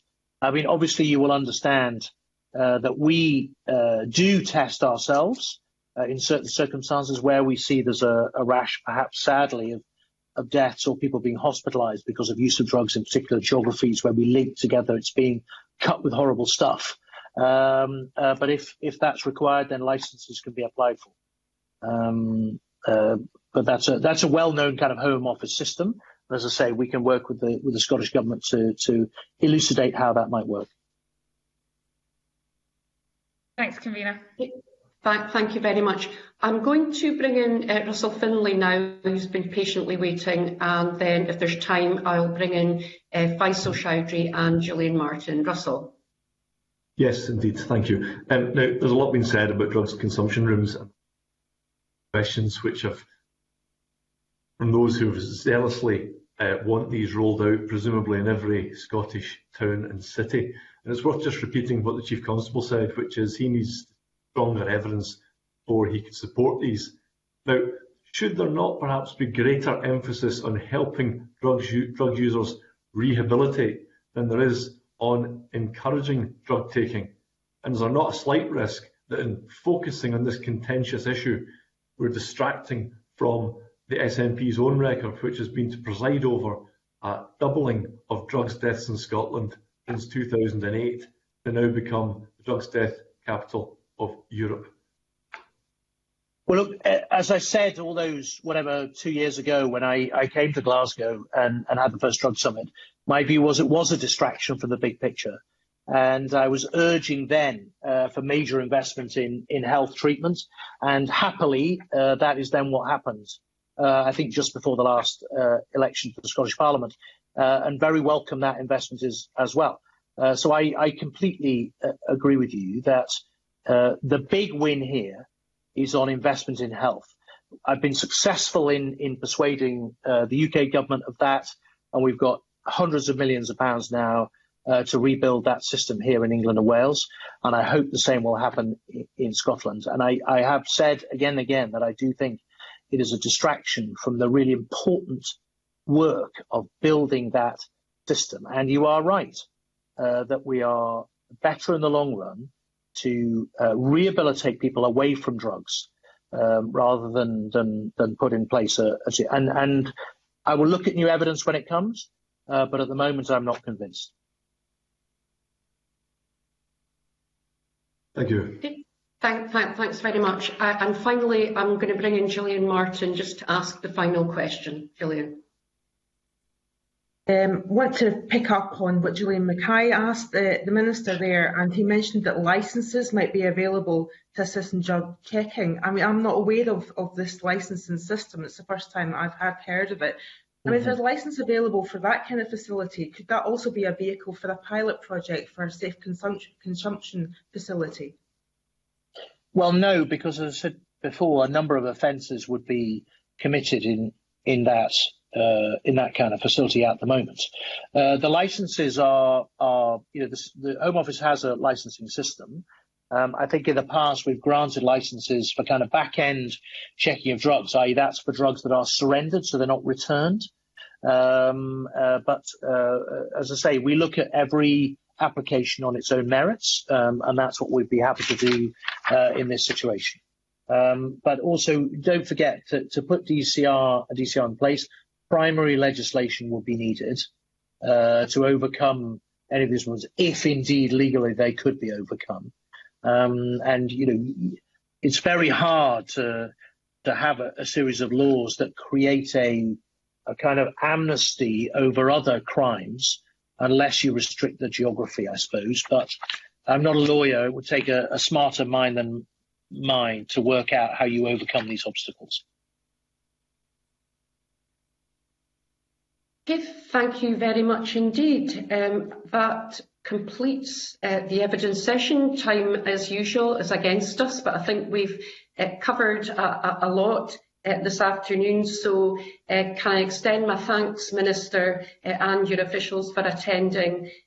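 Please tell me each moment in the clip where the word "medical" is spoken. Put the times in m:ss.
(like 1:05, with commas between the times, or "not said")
not said.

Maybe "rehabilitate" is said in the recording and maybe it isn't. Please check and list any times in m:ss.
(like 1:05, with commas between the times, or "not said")
1:12, 2:33.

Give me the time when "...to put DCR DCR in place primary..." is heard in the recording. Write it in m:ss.
3:52.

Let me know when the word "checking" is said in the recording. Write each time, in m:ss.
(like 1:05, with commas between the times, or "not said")
3:05, 3:36.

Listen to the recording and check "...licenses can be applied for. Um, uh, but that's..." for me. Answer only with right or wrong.
right.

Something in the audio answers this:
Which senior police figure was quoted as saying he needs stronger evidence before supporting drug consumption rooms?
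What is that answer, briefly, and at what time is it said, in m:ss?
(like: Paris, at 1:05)
Chief Constable, at 1:02.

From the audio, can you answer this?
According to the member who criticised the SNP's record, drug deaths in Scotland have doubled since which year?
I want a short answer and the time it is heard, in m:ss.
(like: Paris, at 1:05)
2008, at 1:30.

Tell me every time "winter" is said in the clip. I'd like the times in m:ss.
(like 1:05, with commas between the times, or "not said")
not said.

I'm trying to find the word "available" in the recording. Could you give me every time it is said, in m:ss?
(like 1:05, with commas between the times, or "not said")
3:03, 3:11.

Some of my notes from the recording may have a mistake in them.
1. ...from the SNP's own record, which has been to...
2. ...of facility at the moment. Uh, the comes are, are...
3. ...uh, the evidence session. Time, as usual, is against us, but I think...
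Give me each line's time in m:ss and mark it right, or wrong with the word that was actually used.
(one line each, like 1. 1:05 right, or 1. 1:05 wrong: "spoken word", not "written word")
1. 1:23 right
2. 3:26 wrong: "licenses", not "comes"
3. 4:31 right.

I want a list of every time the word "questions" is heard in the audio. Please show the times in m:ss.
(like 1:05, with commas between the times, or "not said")
0:52, 2:54.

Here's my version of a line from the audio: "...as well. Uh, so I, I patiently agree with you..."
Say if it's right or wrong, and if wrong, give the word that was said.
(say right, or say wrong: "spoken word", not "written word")
wrong: "completely", not "patiently".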